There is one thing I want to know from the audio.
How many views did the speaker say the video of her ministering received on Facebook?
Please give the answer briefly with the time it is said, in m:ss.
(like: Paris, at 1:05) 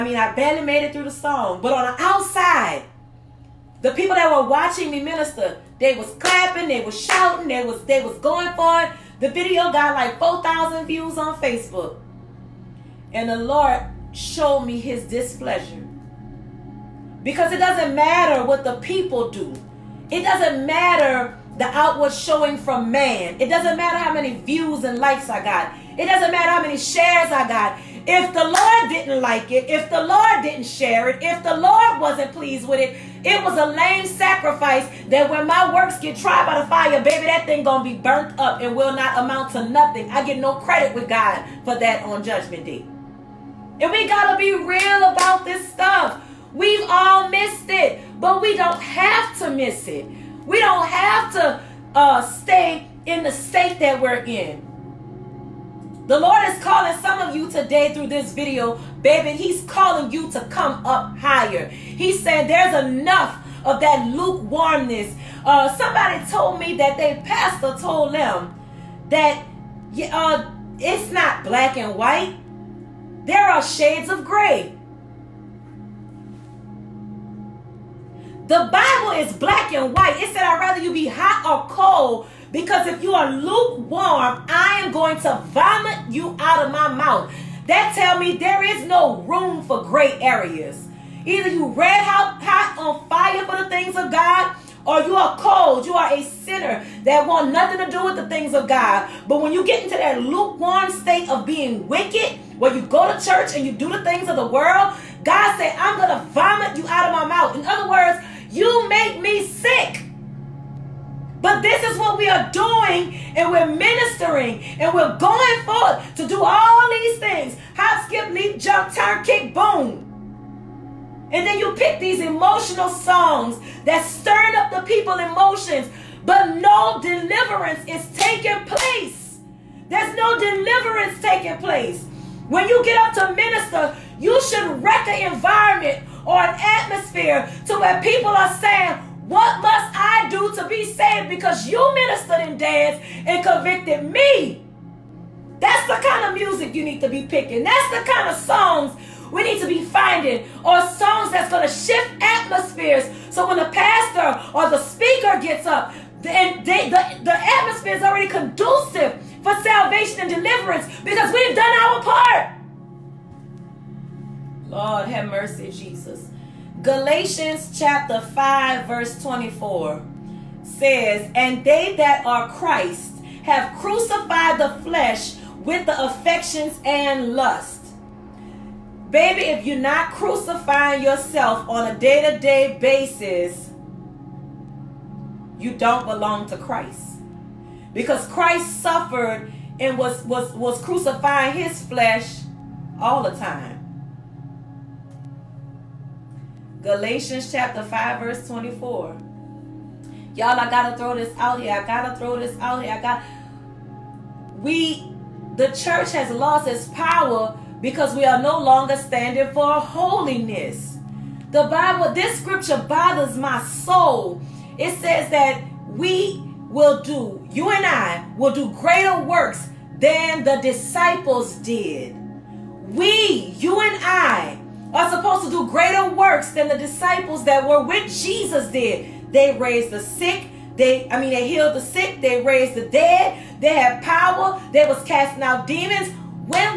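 4,000, at 0:10.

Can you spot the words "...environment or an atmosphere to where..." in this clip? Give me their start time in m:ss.
2:15.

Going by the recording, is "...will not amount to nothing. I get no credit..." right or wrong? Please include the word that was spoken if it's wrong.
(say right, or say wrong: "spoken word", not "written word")
right.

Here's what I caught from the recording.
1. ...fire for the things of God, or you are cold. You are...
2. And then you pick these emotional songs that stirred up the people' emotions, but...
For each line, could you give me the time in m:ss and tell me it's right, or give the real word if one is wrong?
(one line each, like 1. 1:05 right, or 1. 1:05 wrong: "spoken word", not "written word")
1. 1:33 right
2. 2:01 right.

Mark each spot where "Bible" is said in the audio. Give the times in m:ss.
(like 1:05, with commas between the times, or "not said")
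1:18, 3:31.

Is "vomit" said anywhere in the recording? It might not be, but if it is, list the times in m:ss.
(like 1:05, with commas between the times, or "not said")
1:25, 1:46.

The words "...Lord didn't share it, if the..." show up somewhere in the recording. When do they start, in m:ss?
0:30.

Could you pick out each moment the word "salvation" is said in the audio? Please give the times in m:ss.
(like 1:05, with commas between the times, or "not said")
2:39.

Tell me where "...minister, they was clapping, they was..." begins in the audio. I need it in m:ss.
0:05.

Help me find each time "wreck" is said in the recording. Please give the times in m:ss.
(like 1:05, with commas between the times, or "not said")
2:14.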